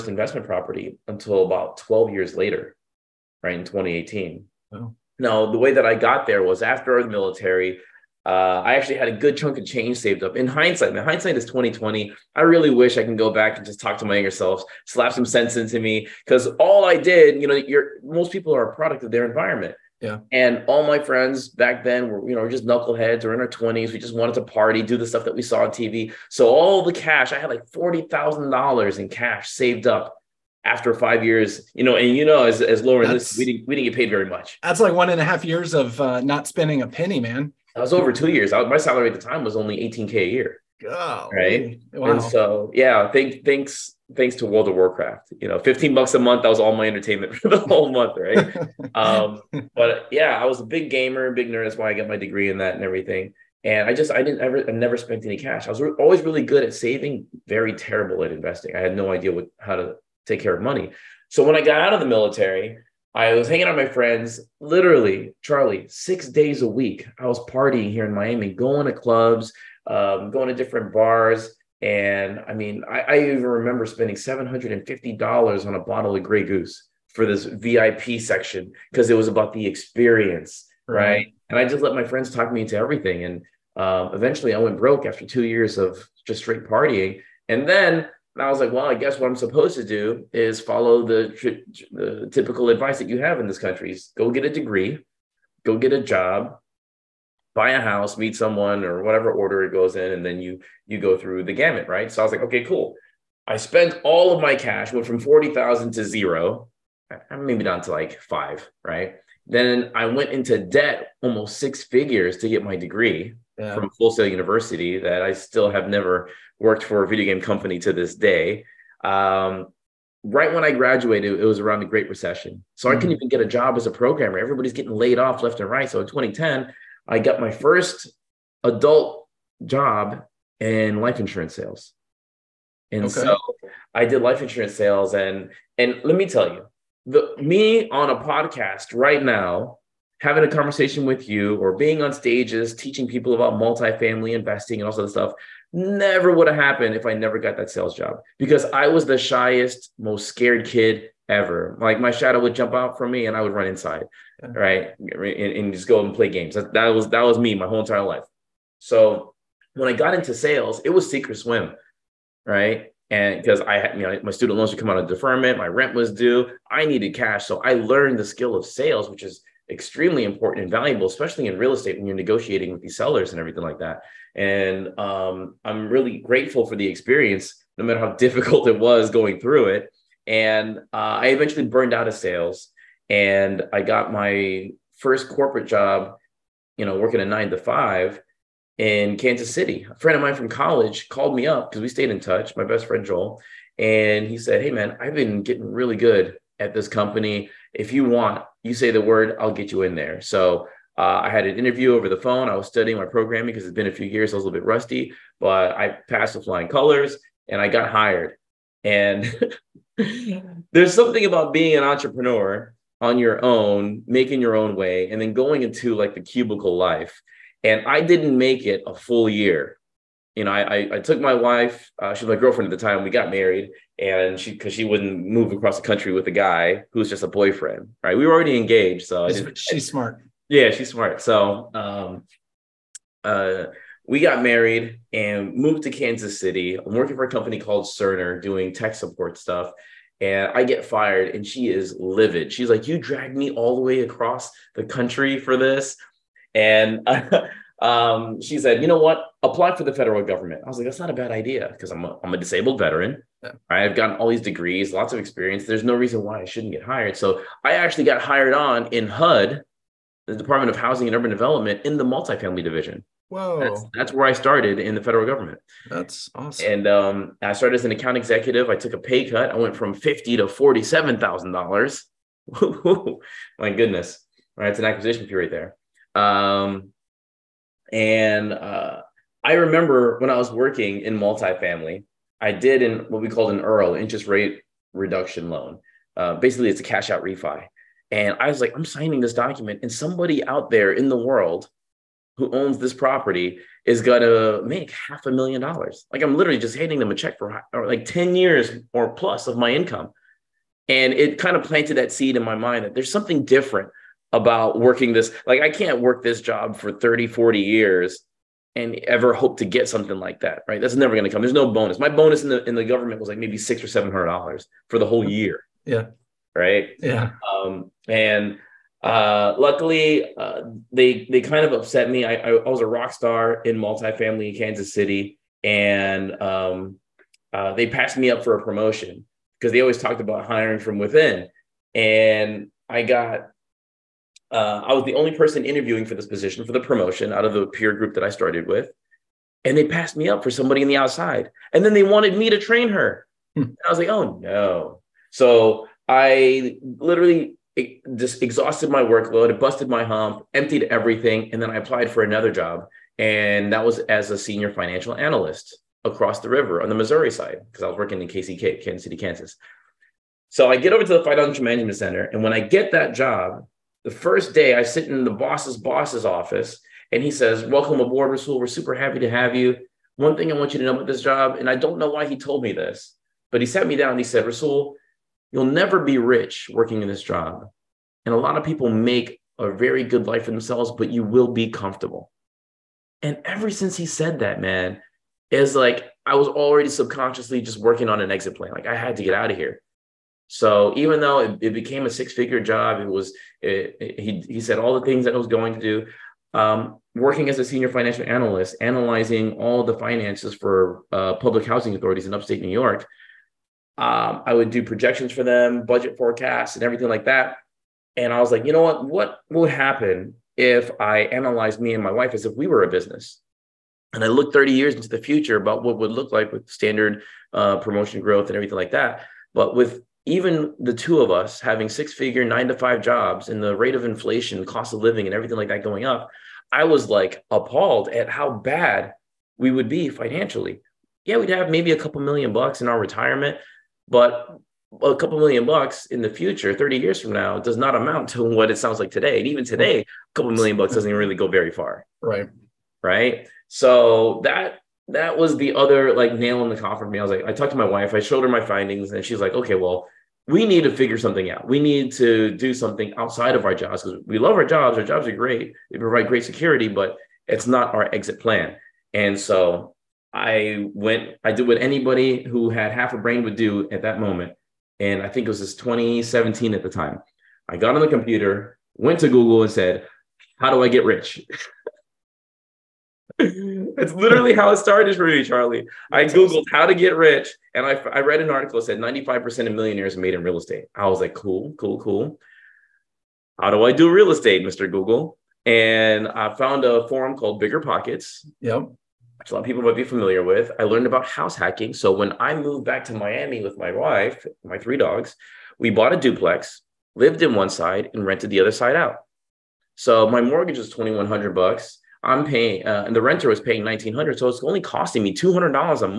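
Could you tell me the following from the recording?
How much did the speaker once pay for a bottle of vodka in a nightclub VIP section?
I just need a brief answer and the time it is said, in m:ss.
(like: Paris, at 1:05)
$750, at 1:14.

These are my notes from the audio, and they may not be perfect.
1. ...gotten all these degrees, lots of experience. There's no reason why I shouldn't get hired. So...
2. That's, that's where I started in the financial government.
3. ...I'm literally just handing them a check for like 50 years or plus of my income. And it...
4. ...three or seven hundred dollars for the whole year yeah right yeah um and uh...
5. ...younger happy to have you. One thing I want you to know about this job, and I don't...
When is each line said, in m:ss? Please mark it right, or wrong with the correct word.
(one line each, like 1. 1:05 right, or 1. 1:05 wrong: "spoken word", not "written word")
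1. 4:13 right
2. 4:23 wrong: "federal", not "financial"
3. 4:56 wrong: "10", not "50"
4. 5:13 wrong: "six", not "three"
5. 6:08 wrong: "super", not "younger".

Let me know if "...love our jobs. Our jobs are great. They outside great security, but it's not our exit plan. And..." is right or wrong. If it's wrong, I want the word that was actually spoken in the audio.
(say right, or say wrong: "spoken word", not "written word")
wrong: "provide", not "outside".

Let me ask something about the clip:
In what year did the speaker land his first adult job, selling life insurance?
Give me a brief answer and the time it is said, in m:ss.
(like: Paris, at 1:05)
2010, at 2:06.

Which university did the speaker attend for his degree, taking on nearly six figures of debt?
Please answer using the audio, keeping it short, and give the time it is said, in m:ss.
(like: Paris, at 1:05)
Full Sail University, at 1:53.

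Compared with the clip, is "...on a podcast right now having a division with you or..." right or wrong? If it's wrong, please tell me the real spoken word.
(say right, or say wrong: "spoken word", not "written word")
wrong: "conversation", not "division".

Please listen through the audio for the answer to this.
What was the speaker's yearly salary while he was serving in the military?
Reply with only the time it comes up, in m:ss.
0:39.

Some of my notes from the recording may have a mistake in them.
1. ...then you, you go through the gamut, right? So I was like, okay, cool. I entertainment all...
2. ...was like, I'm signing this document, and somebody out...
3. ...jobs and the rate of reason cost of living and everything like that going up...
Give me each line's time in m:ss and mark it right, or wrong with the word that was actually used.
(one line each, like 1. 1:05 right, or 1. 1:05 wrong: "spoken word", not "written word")
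1. 1:40 wrong: "spent", not "entertainment"
2. 4:48 right
3. 7:03 wrong: "inflation", not "reason".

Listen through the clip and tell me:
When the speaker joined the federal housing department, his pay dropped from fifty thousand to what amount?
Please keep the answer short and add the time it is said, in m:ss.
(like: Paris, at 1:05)
$47,000, at 4:30.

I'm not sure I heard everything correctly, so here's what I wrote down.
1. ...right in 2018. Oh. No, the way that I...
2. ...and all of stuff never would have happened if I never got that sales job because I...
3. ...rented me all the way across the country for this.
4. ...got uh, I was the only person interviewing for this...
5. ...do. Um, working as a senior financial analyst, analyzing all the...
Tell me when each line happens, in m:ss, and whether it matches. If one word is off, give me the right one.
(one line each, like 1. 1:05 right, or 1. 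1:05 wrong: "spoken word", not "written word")
1. 0:03 right
2. 2:24 right
3. 4:02 wrong: "dragged", not "rented"
4. 5:33 right
5. 6:35 right.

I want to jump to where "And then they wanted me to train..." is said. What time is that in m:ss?
5:41.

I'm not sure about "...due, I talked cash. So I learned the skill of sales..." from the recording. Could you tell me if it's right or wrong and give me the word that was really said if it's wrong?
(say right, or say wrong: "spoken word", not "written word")
wrong: "needed", not "talked".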